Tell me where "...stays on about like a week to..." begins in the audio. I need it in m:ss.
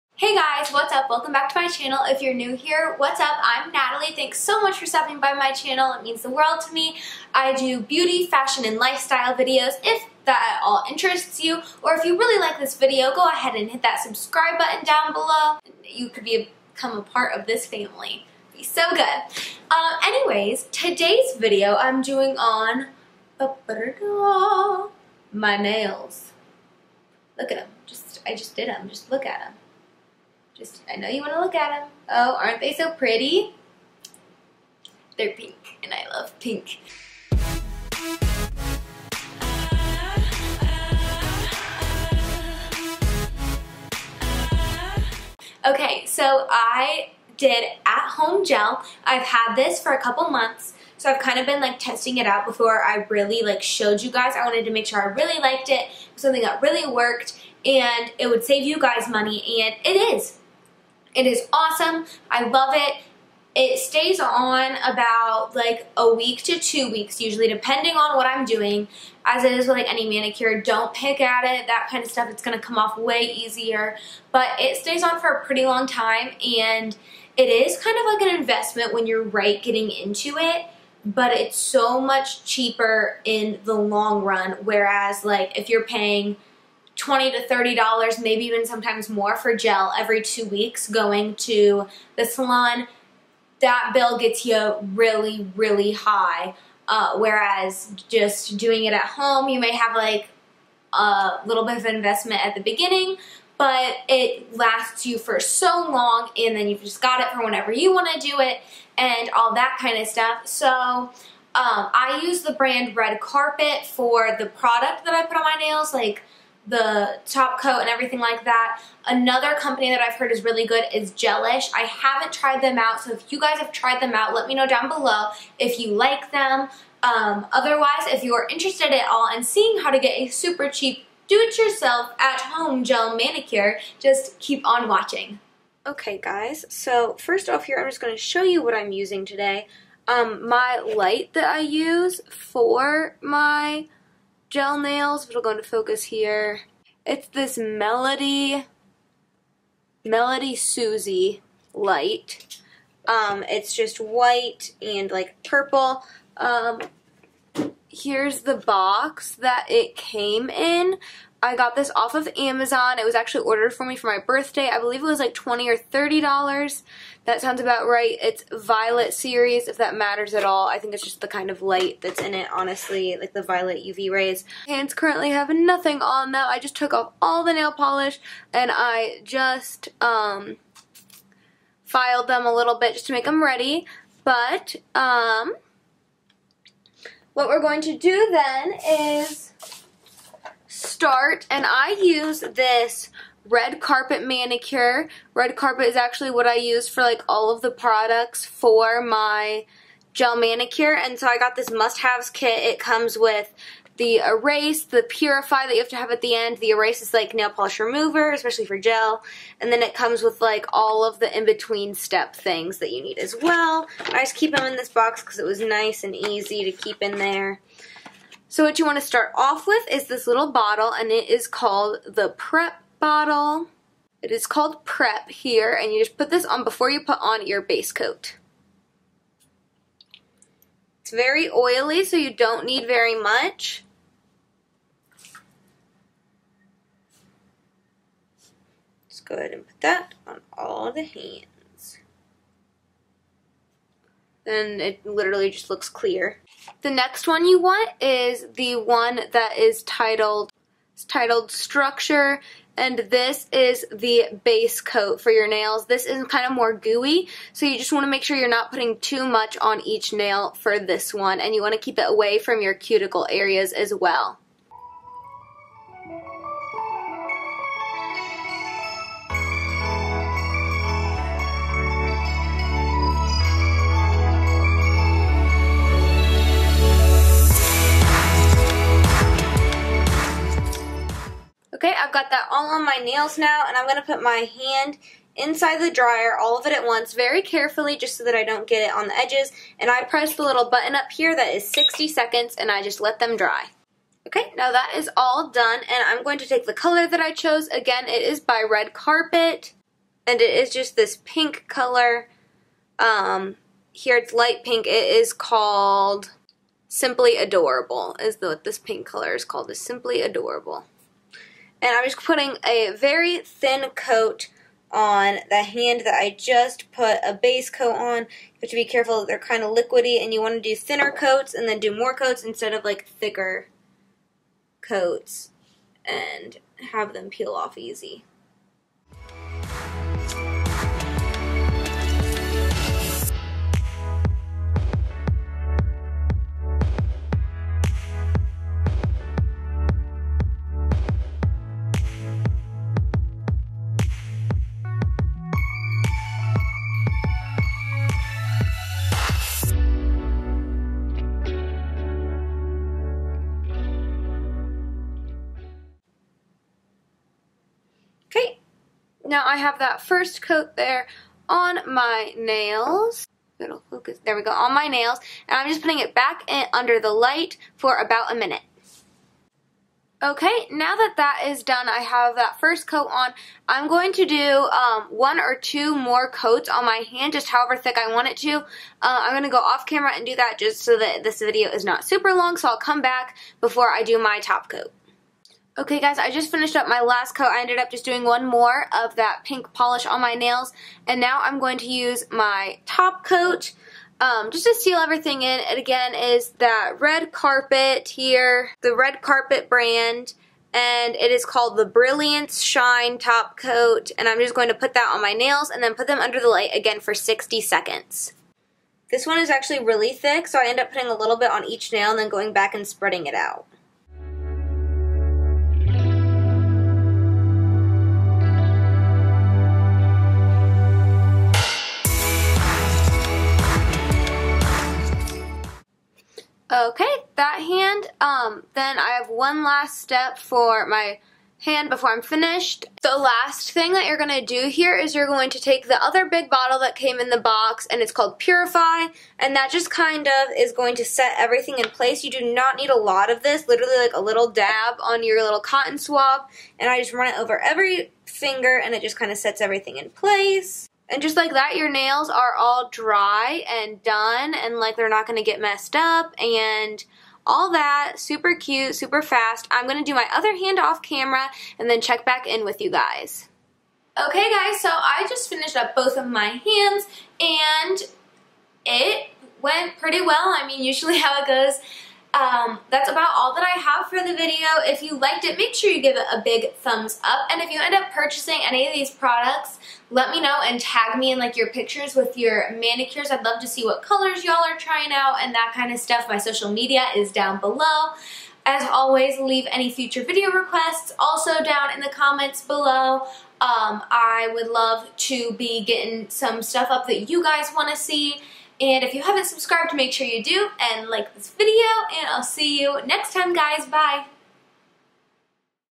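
1:03.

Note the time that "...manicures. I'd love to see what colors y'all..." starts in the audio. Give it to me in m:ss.
8:02.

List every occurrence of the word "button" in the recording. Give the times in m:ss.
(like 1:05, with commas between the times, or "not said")
0:14, 4:50.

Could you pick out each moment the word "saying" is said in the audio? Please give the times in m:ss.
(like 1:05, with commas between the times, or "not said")
not said.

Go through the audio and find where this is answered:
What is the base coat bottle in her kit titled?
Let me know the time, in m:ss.
4:11.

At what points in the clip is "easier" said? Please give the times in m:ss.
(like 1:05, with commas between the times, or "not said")
1:13.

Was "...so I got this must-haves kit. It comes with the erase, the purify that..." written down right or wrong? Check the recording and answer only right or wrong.
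right.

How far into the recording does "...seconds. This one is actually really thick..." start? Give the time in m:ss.
6:47.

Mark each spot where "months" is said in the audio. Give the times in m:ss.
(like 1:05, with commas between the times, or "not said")
0:50.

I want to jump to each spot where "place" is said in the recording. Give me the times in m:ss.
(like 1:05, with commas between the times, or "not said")
7:21, 7:30.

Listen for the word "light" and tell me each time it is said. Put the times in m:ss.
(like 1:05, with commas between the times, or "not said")
2:20, 2:31, 2:51, 5:04, 6:07, 6:46.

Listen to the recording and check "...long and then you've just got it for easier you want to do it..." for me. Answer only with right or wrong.
wrong.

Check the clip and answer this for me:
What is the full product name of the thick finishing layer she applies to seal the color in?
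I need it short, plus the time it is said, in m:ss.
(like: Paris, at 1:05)
Brilliance Shine Top Coat, at 6:41.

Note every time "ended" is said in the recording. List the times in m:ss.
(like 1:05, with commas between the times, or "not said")
6:27.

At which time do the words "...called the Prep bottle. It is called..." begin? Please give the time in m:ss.
3:41.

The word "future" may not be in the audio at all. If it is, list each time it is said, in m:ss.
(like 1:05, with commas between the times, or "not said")
8:09.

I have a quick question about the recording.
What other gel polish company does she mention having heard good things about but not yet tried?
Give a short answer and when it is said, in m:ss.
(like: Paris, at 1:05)
Gelish, at 2:01.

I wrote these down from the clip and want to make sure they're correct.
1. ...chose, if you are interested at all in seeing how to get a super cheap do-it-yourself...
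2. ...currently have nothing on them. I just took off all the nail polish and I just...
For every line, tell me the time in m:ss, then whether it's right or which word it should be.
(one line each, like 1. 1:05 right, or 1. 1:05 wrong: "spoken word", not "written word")
1. 2:07 wrong: "otherwise", not "chose"
2. 2:54 right.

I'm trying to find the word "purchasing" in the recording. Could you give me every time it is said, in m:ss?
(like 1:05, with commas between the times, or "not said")
7:58.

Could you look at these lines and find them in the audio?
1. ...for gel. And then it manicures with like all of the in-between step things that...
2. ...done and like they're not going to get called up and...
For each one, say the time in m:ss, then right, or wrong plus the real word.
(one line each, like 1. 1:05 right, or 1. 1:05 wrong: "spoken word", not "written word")
1. 3:28 wrong: "comes", not "manicures"
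2. 7:34 wrong: "messed", not "called".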